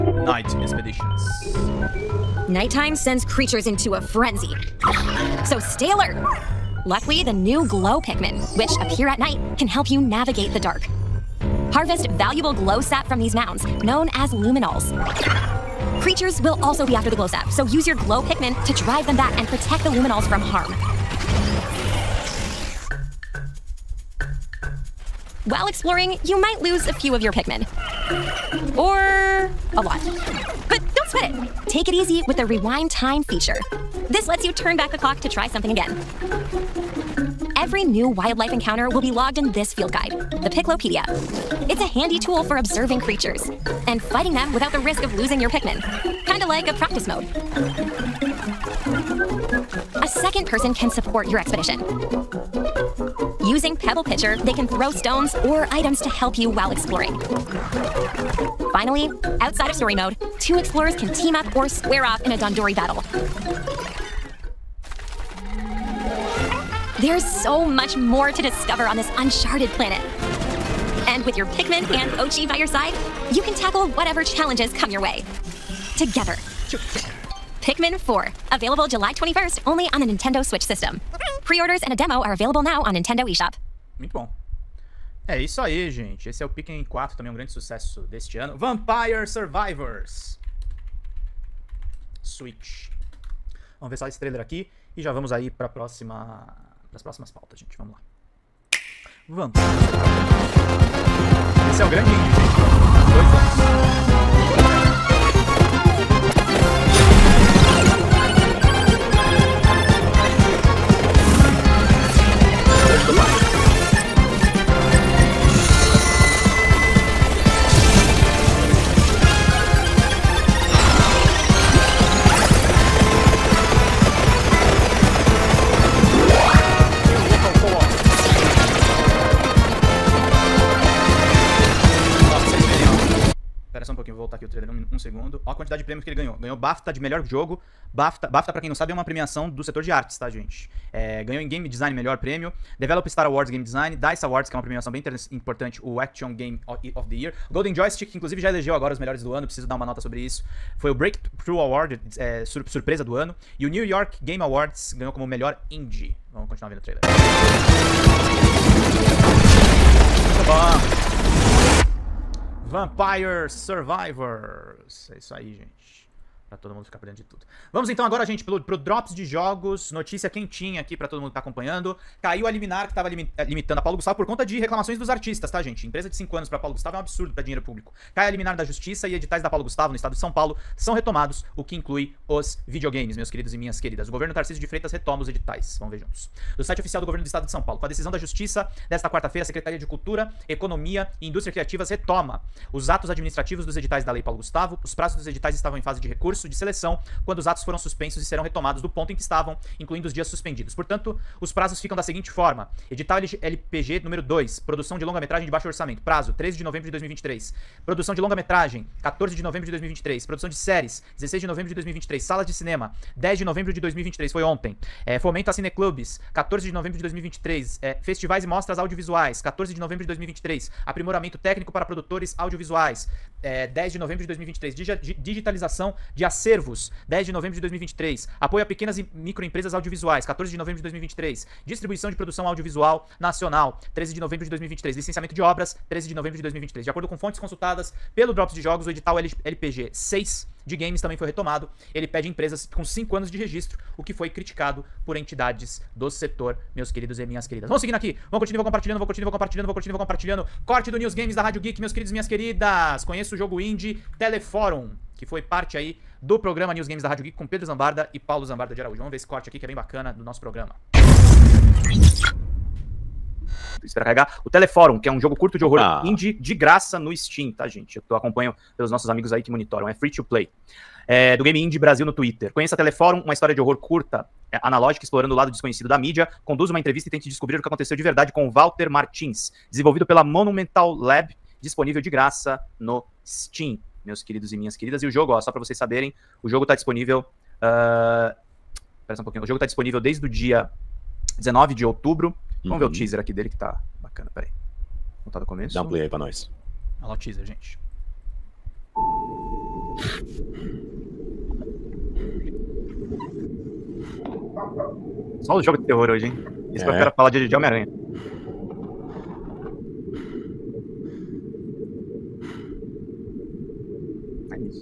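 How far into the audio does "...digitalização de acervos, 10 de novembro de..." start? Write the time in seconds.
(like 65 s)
225 s.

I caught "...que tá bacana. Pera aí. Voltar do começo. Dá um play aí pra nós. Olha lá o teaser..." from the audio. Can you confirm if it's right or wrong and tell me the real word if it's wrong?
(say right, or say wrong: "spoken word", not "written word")
right.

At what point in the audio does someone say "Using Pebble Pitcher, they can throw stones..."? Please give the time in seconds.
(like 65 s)
53 s.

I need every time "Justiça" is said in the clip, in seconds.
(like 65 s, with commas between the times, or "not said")
178 s, 188 s.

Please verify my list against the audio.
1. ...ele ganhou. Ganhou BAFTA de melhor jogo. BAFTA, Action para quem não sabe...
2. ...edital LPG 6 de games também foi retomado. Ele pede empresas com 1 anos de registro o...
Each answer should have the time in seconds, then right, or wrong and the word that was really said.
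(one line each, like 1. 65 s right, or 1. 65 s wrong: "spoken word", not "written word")
1. 136 s wrong: "BAFTA", not "Action"
2. 238 s wrong: "5", not "1".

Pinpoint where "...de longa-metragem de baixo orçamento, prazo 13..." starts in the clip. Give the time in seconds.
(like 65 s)
204 s.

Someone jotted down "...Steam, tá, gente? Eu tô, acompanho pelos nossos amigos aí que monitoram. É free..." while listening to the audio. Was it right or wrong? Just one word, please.
right.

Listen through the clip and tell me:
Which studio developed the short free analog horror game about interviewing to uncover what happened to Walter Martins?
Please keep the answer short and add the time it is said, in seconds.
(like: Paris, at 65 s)
Monumental Lab, at 280 s.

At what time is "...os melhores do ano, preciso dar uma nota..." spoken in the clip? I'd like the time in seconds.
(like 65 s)
148 s.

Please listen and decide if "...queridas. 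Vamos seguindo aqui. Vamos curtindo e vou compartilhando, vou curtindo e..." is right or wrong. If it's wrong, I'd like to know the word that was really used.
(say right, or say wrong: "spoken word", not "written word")
right.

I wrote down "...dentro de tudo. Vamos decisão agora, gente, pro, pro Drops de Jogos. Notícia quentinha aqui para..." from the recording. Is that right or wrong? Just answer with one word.
wrong.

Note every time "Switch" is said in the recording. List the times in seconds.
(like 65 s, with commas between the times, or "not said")
80 s, 92 s.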